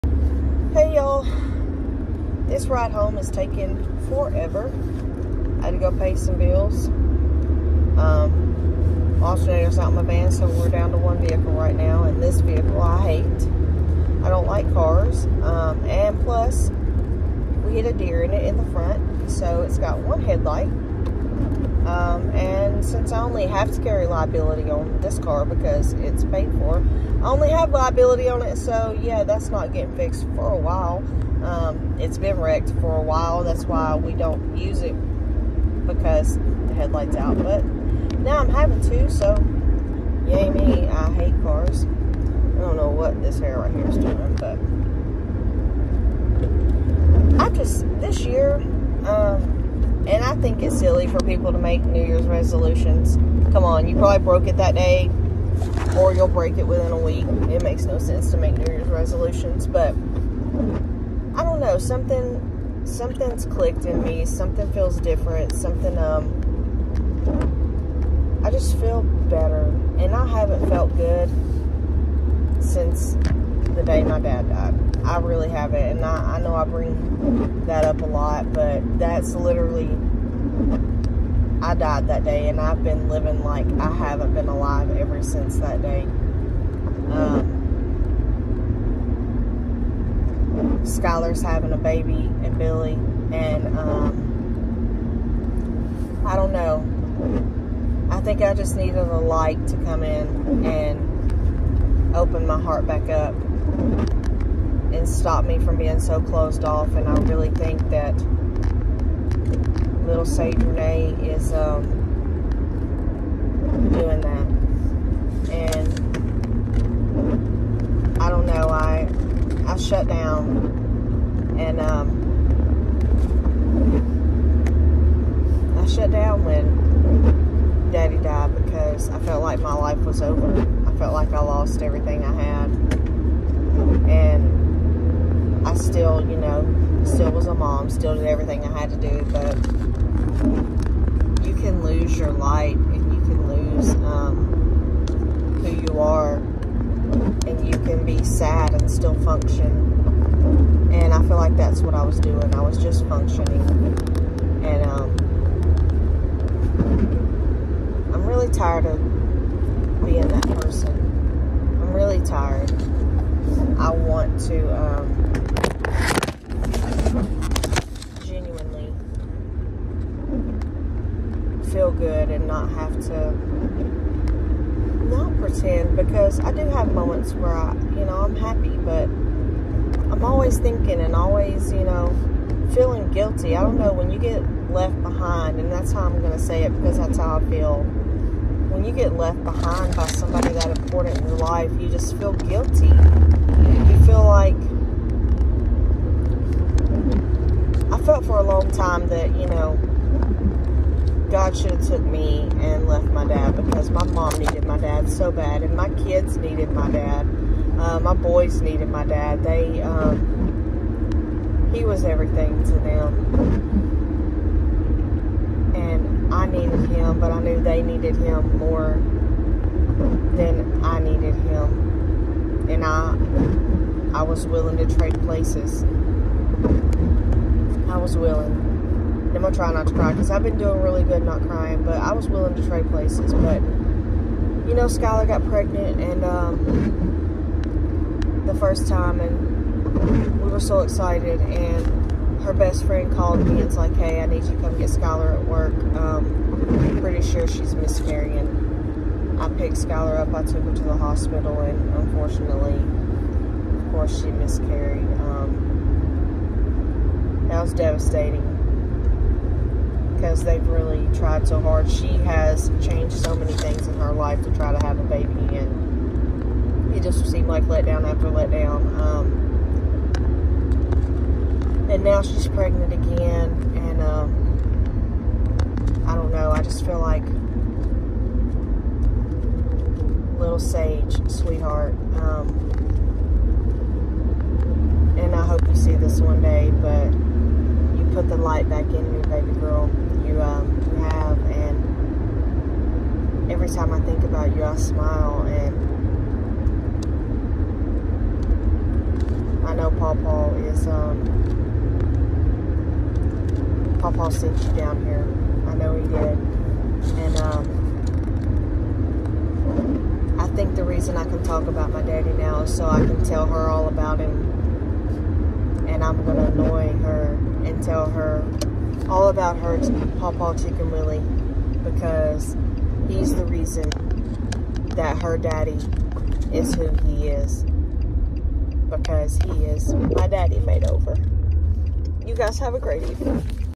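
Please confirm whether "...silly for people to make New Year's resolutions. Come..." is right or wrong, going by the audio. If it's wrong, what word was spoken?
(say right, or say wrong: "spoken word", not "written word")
right.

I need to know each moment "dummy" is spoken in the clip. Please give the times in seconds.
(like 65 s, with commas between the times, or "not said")
not said.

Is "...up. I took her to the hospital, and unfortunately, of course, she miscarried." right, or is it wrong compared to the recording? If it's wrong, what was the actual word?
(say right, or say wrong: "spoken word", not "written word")
right.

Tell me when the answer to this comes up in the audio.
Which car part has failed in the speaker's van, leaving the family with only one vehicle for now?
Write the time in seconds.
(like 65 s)
9 s.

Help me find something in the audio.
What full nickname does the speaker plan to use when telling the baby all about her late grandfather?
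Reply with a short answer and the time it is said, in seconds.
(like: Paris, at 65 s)
Paw Paw Chicken Willie, at 320 s.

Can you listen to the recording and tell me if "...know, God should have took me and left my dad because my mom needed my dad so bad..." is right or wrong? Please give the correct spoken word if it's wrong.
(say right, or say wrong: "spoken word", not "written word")
right.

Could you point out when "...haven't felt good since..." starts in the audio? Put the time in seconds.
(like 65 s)
70 s.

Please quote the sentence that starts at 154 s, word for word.
And um, I'm really tired of being that person.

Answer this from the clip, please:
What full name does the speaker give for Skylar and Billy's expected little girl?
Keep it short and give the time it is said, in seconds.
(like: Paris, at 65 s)
Sage Renee, at 110 s.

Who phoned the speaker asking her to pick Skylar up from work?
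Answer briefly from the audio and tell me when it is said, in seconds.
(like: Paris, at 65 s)
her best friend, at 242 s.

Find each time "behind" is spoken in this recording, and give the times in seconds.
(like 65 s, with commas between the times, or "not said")
185 s, 189 s.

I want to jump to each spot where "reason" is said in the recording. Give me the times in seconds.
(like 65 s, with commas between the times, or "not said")
310 s, 323 s.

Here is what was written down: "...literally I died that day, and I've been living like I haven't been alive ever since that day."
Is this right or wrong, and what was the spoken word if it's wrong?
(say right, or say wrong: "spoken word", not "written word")
right.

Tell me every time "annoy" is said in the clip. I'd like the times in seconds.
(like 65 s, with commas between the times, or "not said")
316 s.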